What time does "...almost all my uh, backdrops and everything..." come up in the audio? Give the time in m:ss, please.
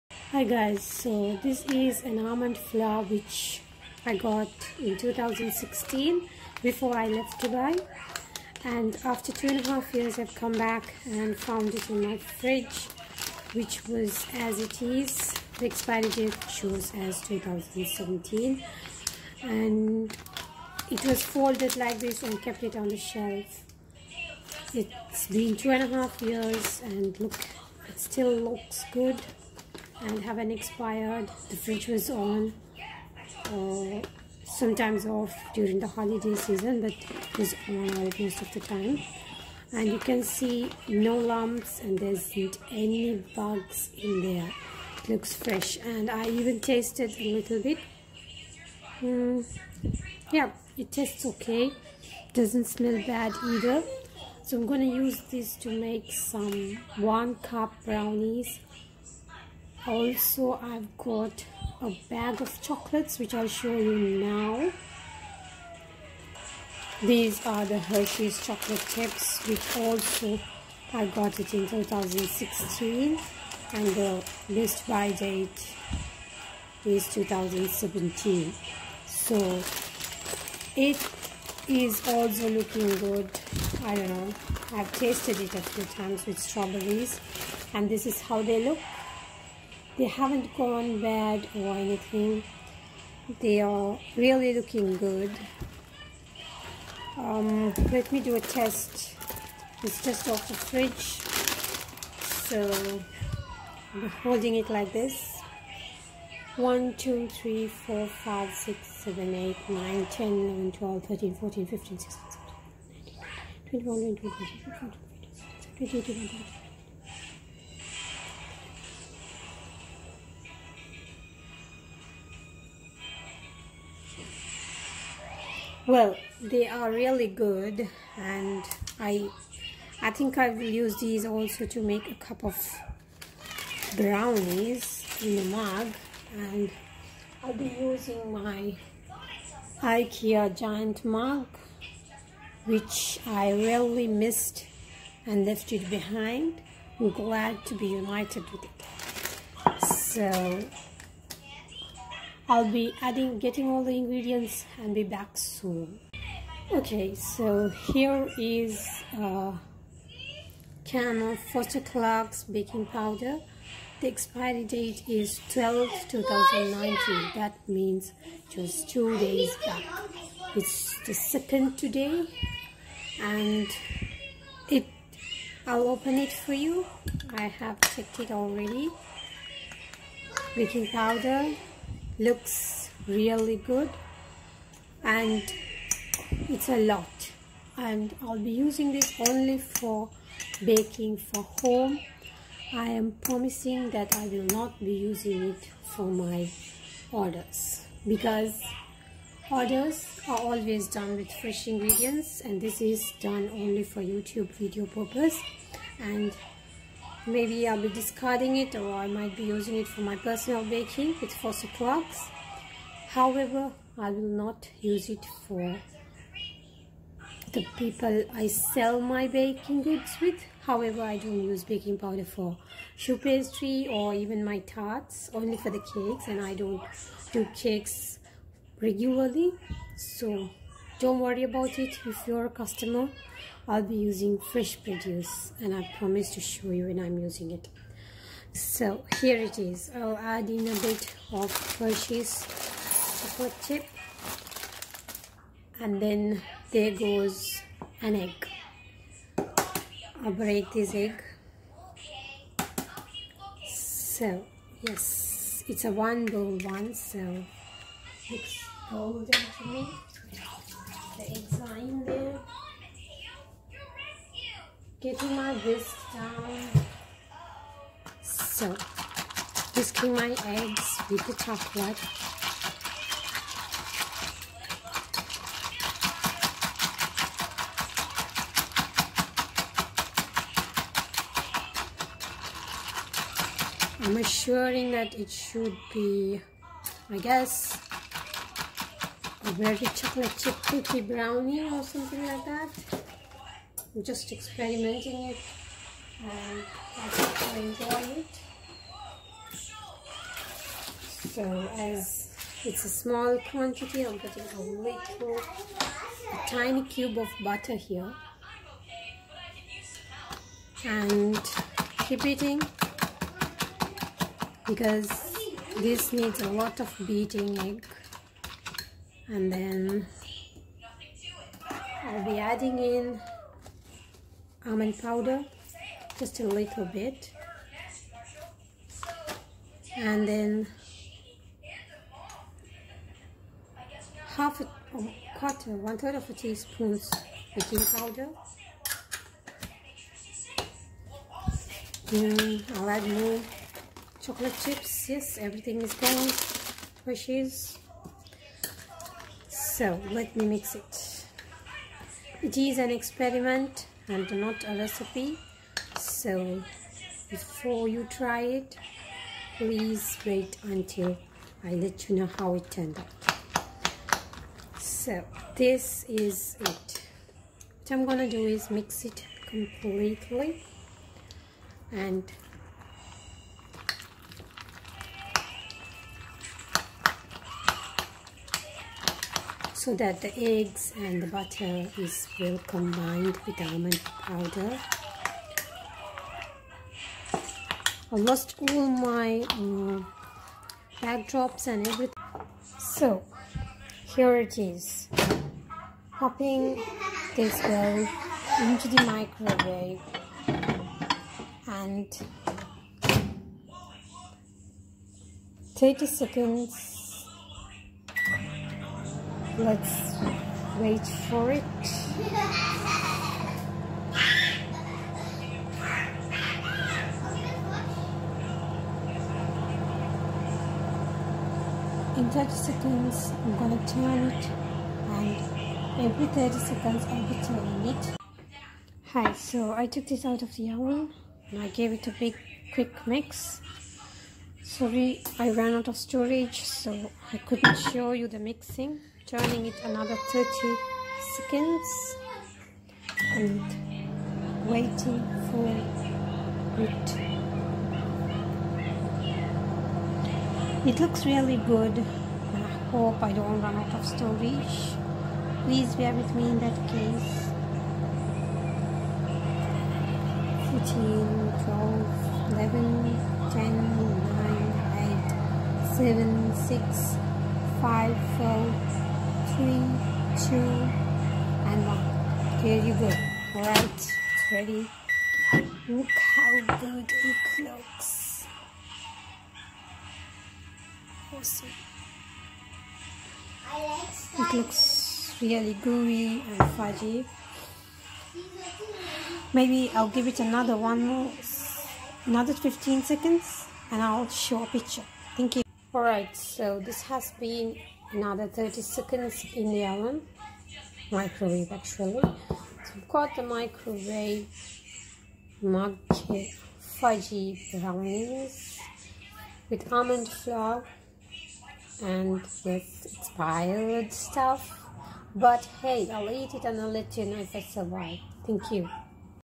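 6:28.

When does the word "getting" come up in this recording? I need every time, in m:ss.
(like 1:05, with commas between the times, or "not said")
2:33, 4:25.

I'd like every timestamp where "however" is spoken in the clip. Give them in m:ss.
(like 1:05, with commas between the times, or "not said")
3:33, 3:40.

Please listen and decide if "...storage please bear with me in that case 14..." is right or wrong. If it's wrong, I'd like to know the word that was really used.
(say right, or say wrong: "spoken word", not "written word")
right.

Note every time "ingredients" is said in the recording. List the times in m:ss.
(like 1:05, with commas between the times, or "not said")
2:33, 3:21.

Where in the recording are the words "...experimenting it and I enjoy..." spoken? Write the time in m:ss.
4:54.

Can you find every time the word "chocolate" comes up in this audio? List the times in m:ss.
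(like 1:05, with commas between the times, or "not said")
1:02, 1:08, 4:03, 4:31, 4:49, 5:44.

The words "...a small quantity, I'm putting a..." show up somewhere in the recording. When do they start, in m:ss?
5:02.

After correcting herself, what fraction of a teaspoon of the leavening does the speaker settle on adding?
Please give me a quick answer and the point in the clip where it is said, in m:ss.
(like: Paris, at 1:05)
one third, at 5:35.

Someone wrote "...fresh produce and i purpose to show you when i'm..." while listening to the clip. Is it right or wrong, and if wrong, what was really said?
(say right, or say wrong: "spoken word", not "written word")
wrong: "promise", not "purpose".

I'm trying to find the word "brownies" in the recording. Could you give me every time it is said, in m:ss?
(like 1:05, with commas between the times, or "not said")
0:57, 2:13, 4:51, 8:27.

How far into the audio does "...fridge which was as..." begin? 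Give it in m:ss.
0:12.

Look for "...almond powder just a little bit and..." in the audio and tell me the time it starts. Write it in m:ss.
5:24.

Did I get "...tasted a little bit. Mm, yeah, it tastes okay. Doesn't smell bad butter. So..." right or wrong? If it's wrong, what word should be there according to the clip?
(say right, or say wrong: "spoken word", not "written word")
wrong: "either", not "butter".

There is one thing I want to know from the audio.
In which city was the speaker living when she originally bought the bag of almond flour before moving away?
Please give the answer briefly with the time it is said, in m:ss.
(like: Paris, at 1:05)
Dubai, at 0:07.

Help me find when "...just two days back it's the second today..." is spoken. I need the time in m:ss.
2:48.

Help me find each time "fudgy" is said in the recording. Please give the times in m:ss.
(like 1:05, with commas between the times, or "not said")
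8:06, 8:26.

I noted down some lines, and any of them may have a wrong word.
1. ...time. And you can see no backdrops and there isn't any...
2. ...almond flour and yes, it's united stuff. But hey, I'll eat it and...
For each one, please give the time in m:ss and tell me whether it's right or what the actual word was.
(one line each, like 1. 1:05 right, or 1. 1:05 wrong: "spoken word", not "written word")
1. 0:38 wrong: "lumps", not "backdrops"
2. 8:29 wrong: "piled", not "united".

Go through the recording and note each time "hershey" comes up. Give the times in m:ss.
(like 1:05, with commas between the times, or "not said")
1:07, 4:01, 5:47.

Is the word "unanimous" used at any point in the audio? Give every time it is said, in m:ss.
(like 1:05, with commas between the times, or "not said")
not said.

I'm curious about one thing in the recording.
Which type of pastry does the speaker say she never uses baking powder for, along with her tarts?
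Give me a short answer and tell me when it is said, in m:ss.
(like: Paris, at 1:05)
choux pastry, at 3:42.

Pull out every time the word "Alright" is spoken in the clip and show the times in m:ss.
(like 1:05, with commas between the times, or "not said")
8:15.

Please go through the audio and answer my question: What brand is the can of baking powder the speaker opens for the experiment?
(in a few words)
Foster Clark's.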